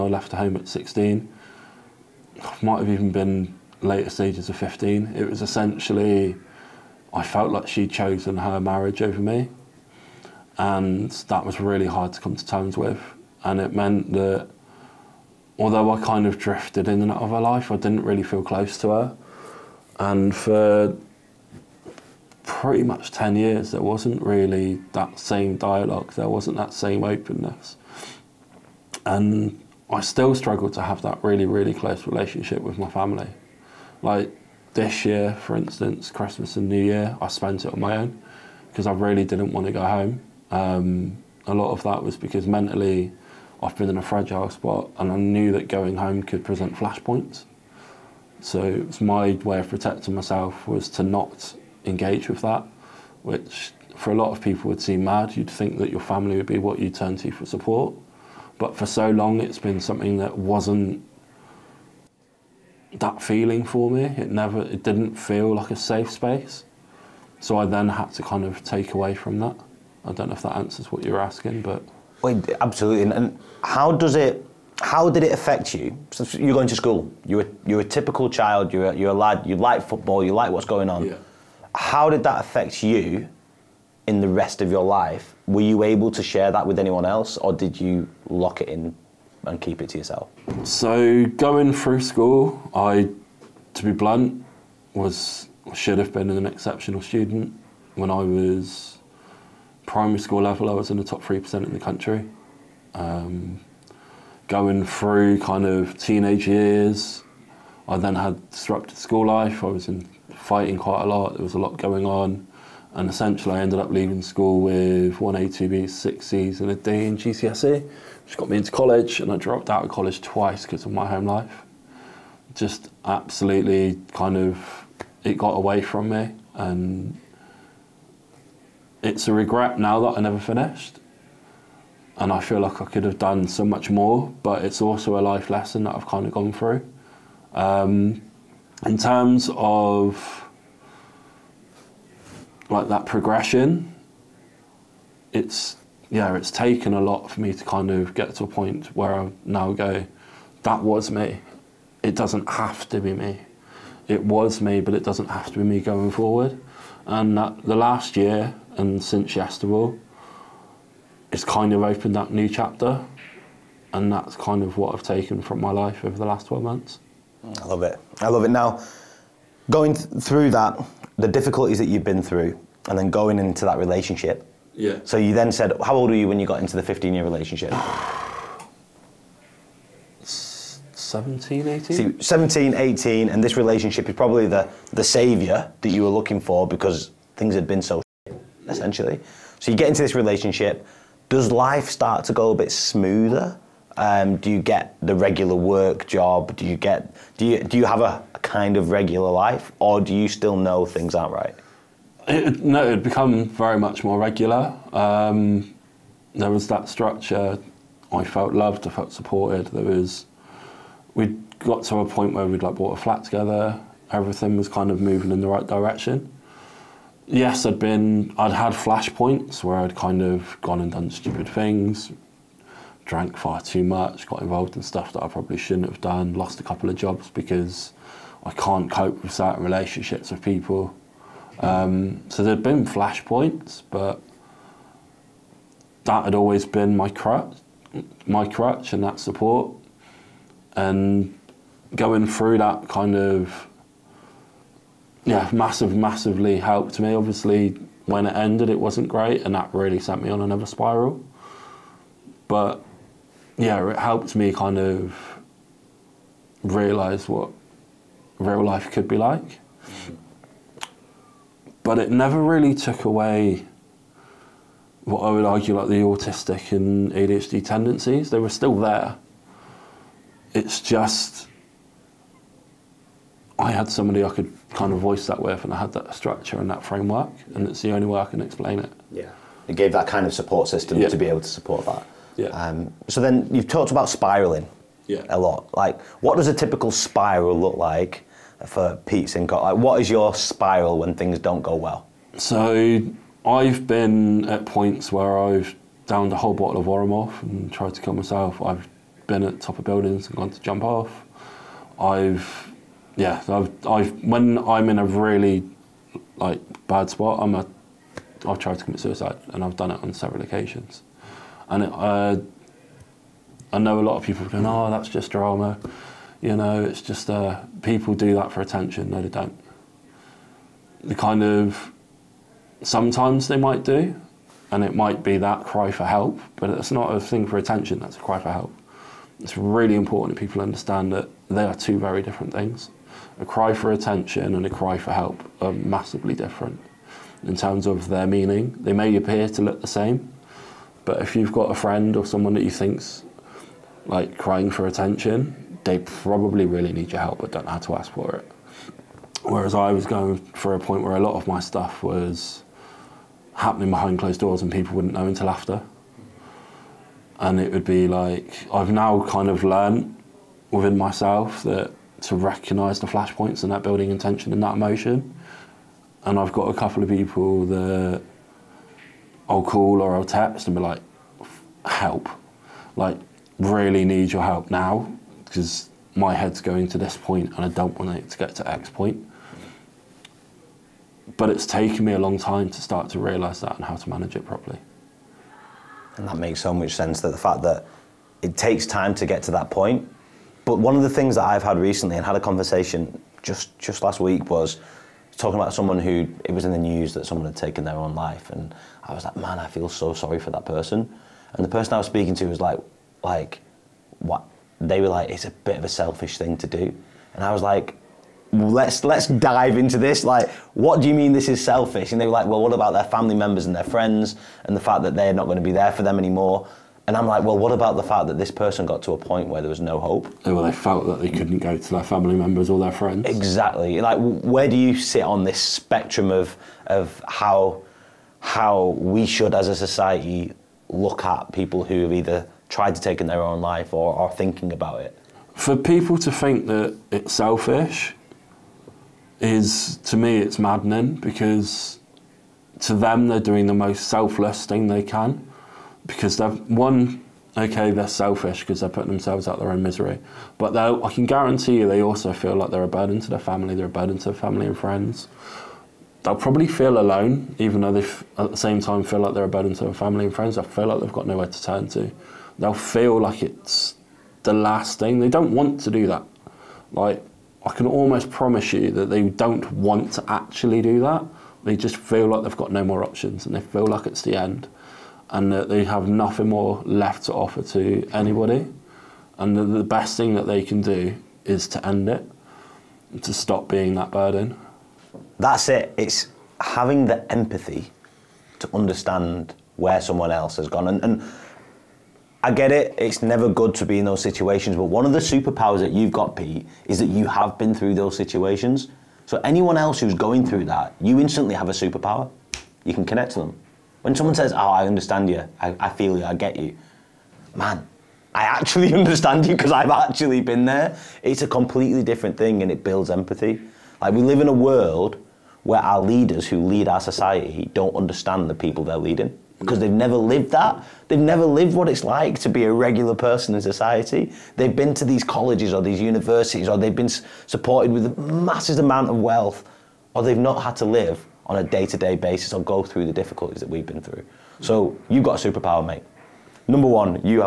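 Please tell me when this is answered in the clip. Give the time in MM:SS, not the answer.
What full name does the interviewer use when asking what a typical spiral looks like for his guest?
04:49.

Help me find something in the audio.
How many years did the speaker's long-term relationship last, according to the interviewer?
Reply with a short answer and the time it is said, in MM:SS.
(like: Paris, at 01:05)
15, at 02:56.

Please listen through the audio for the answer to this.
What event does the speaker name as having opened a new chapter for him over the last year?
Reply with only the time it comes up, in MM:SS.
02:39.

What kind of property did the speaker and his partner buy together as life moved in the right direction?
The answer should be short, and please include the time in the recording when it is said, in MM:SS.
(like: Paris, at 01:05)
a flat, at 03:33.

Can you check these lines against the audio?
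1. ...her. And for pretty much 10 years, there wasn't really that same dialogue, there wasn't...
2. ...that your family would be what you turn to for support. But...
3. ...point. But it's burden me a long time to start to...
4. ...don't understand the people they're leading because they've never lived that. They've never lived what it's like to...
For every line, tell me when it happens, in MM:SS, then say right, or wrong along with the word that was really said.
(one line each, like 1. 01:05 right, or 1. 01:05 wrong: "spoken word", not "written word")
1. 00:18 right
2. 00:55 right
3. 06:18 wrong: "taken", not "burden"
4. 08:37 right.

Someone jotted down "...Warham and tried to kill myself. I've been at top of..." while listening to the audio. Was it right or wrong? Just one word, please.
right.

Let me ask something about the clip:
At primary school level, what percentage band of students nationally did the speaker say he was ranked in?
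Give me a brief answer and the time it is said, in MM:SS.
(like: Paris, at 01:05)
top 3%, at 01:41.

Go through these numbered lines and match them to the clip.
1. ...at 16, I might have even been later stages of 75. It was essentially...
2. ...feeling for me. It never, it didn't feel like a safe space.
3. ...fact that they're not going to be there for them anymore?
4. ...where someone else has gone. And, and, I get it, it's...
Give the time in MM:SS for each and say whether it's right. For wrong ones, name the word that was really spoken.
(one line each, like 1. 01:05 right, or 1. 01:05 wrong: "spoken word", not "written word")
1. 00:00 wrong: "15", not "75"
2. 01:03 right
3. 06:54 right
4. 08:09 right.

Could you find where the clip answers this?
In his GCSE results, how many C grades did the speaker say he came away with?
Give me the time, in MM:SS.
01:55.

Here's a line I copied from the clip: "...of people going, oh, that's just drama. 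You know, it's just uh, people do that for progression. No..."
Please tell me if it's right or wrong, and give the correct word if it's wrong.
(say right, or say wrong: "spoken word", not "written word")
wrong: "attention", not "progression".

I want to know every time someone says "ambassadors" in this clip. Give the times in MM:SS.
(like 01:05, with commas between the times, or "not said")
not said.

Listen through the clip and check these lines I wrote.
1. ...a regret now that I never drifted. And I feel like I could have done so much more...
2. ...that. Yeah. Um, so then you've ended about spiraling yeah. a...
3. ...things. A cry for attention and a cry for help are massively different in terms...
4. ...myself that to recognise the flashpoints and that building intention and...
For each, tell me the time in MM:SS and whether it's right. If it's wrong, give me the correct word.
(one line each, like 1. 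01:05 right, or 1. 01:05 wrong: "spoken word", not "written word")
1. 02:09 wrong: "finished", not "drifted"
2. 04:41 wrong: "talked", not "ended"
3. 05:32 right
4. 06:00 right.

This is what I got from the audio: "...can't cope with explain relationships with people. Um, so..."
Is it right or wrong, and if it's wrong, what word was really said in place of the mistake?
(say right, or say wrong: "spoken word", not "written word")
wrong: "certain", not "explain".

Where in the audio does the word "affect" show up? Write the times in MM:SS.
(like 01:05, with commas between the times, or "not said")
01:15, 01:22.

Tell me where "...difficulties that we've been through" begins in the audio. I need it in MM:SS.
08:53.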